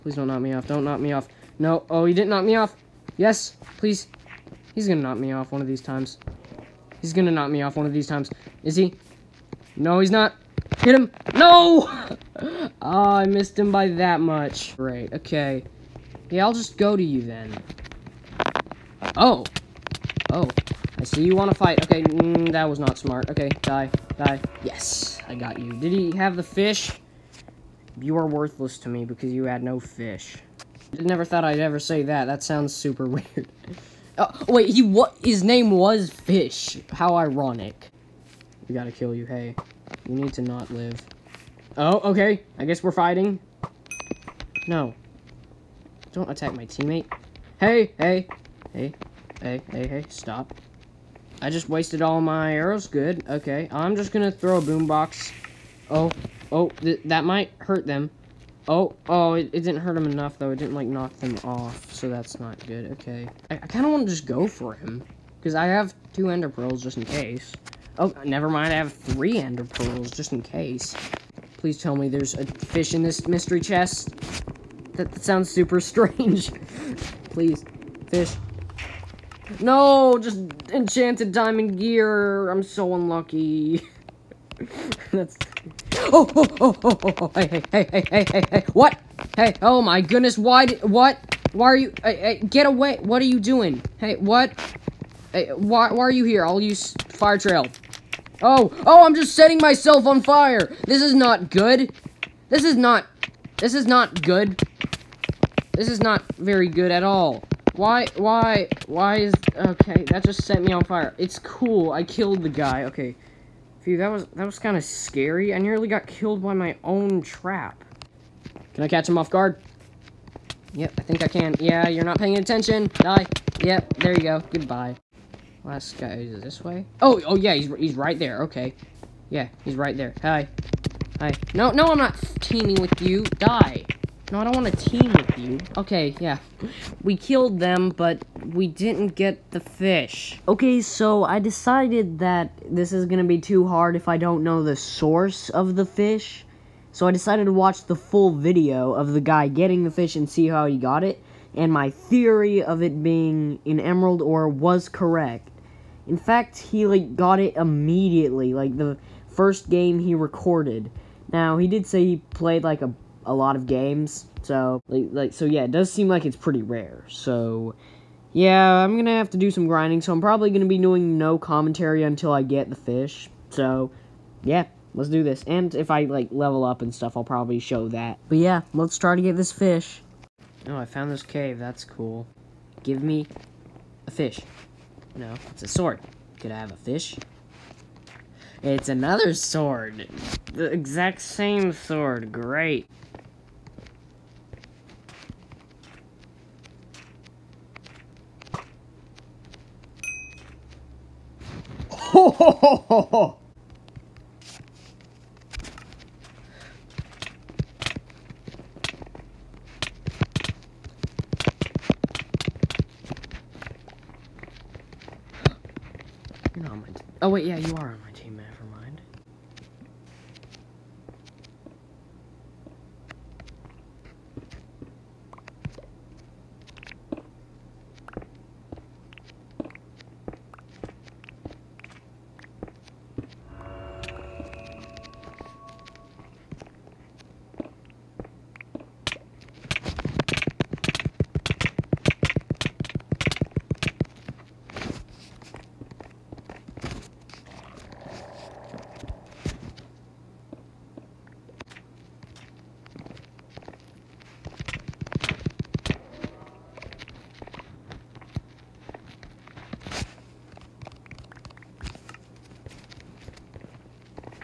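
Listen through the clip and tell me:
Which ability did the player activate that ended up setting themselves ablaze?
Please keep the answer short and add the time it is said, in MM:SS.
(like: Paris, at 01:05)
fire trail, at 01:37.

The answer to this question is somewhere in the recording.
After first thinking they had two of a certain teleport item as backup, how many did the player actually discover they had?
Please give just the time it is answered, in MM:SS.
01:08.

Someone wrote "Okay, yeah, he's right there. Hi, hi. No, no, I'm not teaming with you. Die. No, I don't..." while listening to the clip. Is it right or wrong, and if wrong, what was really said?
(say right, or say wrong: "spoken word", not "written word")
right.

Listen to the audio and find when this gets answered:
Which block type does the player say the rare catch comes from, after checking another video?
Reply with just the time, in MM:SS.
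02:33.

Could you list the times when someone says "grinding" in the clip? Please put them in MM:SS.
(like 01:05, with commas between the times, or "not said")
02:49.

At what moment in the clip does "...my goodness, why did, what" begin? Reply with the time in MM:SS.
01:29.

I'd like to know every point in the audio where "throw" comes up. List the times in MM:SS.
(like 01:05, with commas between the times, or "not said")
00:54.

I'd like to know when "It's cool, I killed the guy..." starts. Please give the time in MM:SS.
01:51.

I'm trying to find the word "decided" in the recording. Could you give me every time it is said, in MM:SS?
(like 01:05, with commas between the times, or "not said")
02:21, 02:27.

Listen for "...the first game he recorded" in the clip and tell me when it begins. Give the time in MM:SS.
02:38.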